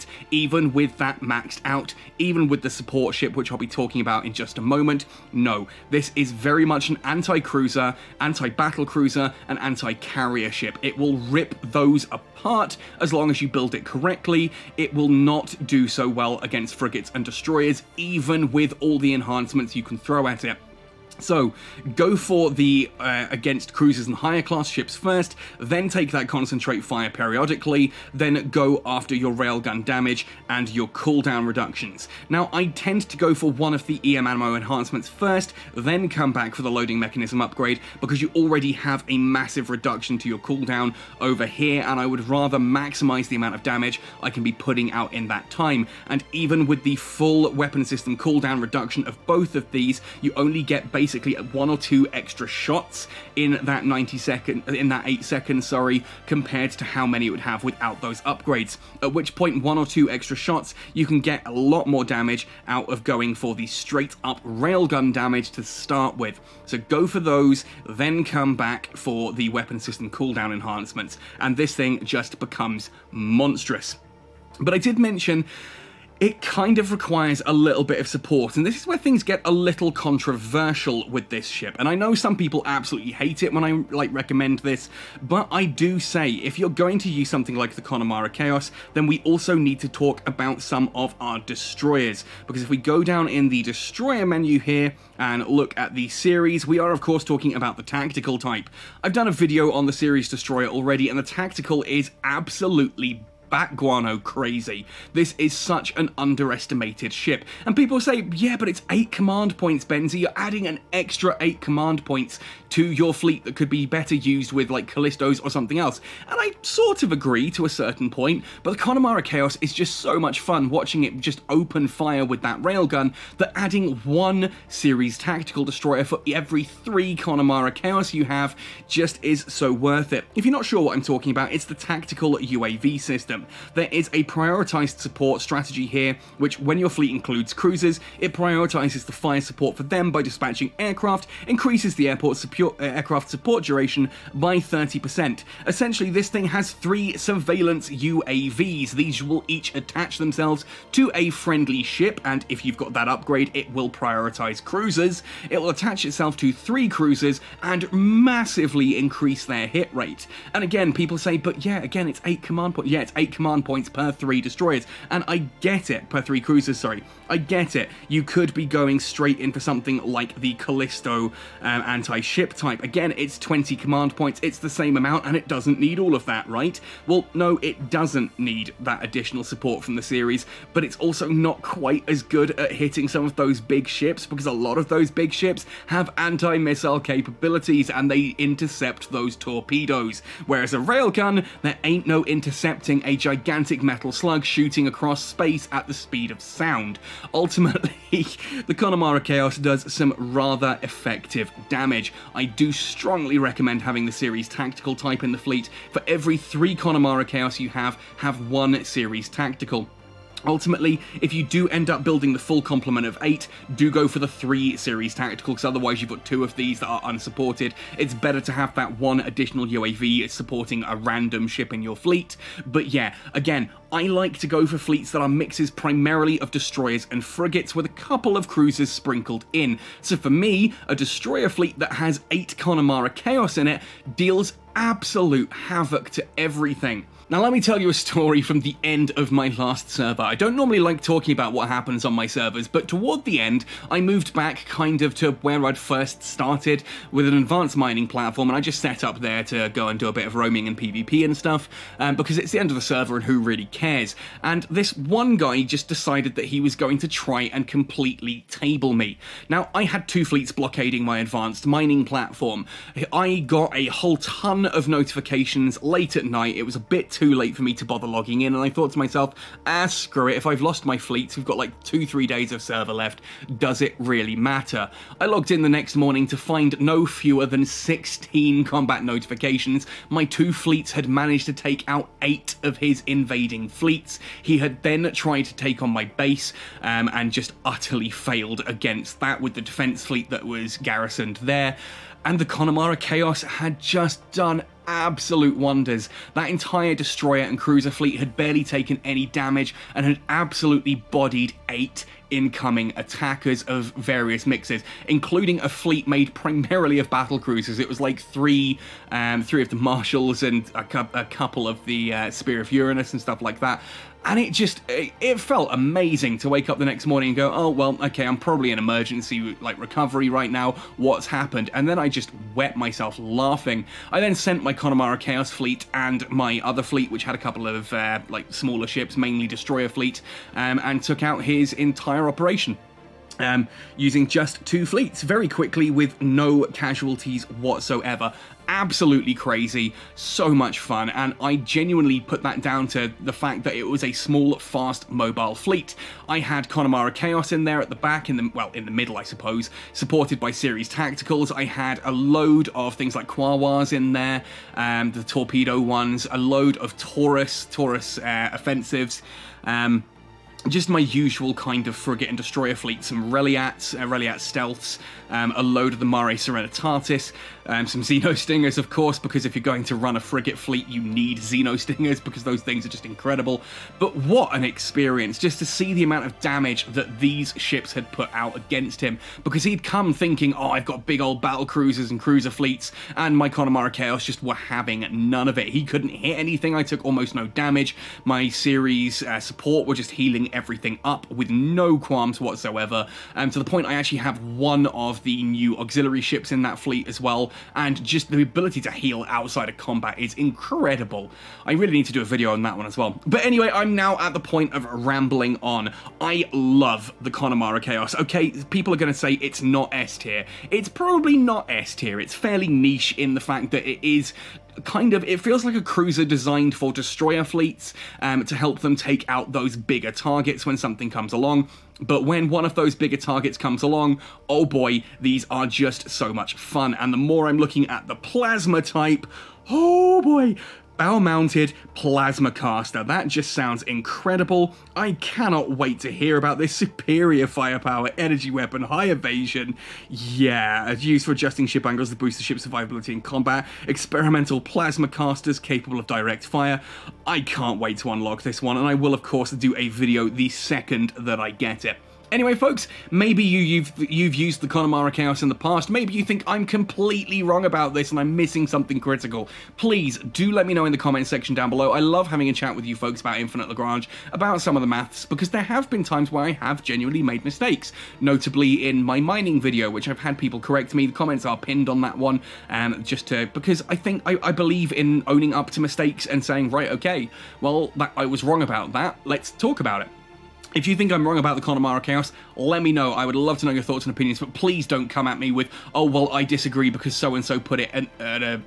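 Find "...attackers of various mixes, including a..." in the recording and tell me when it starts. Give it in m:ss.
5:02.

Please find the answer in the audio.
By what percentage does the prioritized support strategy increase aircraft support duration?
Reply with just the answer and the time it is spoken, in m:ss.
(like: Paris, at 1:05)
30%, at 2:24.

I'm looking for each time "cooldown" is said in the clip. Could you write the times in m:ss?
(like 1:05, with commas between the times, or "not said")
0:30, 0:40, 0:48, 1:10.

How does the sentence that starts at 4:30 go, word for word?
If I've lost my fleets, we've got like two, three days of server left.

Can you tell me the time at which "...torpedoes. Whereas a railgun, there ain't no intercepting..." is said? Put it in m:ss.
3:09.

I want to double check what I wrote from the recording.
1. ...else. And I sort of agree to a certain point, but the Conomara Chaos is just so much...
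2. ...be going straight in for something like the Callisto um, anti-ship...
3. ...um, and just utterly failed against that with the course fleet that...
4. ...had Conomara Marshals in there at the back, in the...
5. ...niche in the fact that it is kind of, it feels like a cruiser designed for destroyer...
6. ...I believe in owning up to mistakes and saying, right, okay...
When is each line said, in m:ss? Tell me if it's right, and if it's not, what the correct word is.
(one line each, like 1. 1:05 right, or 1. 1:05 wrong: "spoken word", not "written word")
1. 1:55 right
2. 2:48 right
3. 4:46 wrong: "defense", not "course"
4. 5:46 wrong: "Chaos", not "Marshals"
5. 6:52 right
6. 7:54 right.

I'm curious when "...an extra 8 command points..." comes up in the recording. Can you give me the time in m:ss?
1:50.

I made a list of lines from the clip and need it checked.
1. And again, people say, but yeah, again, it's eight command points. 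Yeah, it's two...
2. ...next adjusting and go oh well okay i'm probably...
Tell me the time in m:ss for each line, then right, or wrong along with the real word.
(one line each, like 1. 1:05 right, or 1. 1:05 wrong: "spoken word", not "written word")
1. 2:40 wrong: "eight", not "two"
2. 5:16 wrong: "morning", not "adjusting".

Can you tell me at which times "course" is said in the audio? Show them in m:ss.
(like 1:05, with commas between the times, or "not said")
1:37, 6:08, 7:29.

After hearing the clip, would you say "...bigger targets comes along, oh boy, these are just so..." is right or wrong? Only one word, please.
right.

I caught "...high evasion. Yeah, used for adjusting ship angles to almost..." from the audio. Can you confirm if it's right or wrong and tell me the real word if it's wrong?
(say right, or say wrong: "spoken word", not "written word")
wrong: "boost", not "almost".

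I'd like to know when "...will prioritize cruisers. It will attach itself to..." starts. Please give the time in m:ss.
2:33.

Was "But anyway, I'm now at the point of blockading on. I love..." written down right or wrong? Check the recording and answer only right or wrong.
wrong.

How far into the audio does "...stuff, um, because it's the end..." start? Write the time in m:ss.
4:11.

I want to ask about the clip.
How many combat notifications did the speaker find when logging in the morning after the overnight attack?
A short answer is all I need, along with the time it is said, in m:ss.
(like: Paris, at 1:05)
16, at 4:37.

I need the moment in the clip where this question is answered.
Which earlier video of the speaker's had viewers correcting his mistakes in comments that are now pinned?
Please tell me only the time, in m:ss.
7:49.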